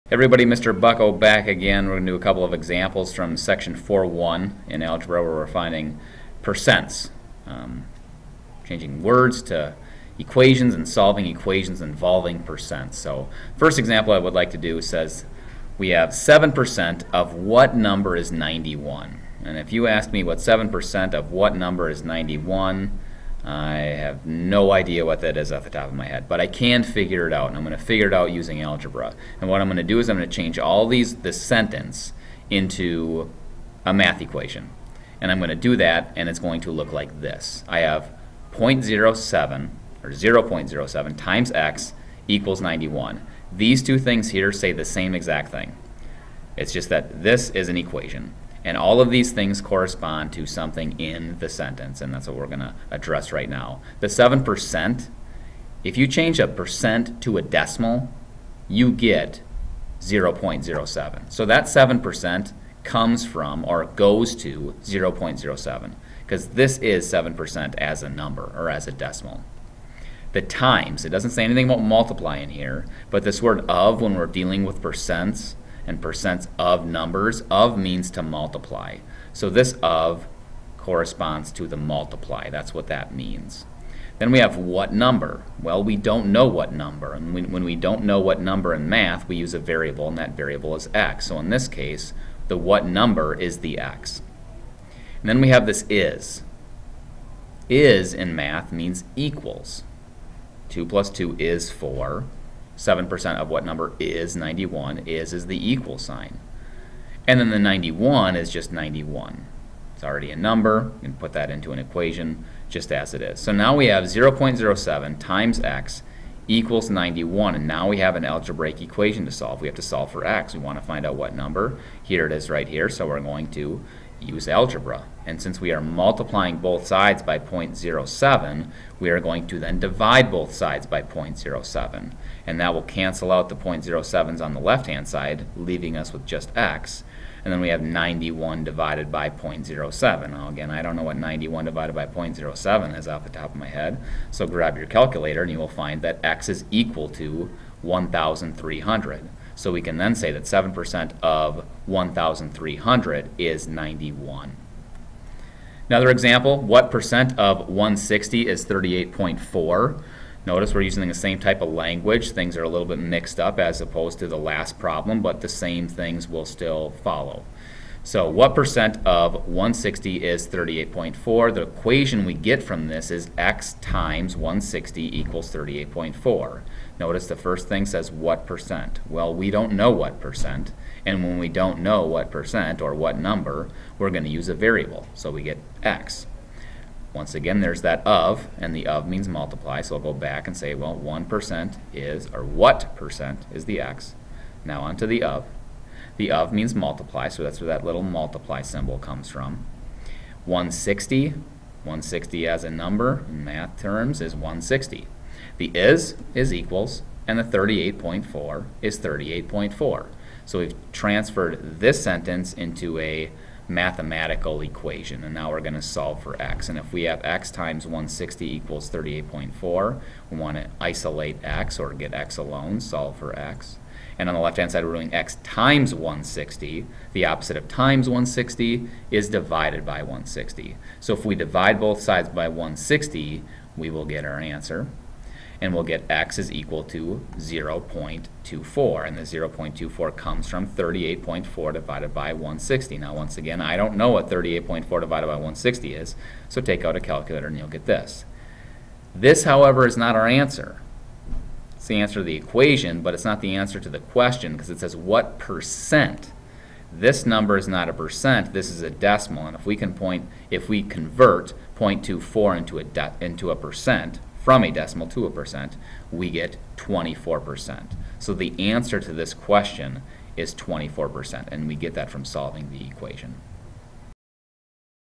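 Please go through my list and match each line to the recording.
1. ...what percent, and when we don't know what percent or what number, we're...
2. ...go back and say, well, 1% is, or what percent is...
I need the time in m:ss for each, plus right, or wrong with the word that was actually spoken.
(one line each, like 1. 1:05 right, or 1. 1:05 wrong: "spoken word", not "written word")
1. 2:59 right
2. 3:10 right.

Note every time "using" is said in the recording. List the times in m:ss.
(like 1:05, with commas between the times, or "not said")
0:28, 2:40.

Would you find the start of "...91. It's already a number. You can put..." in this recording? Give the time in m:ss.
1:48.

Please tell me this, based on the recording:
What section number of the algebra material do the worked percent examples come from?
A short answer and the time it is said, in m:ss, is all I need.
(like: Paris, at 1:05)
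4.1, at 0:03.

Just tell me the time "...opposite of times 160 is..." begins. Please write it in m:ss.
3:47.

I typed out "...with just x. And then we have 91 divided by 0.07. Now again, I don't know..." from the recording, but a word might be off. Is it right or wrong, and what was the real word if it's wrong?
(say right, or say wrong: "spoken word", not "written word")
right.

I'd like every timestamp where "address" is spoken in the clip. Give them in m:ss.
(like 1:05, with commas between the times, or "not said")
0:52.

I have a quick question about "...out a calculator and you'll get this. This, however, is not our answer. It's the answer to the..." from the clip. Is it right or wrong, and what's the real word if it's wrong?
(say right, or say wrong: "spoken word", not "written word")
right.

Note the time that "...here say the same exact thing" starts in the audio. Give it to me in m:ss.
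0:44.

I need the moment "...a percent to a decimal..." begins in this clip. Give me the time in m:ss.
0:56.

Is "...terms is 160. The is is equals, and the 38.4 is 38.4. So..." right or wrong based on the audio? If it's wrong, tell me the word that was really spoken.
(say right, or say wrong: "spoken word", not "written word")
right.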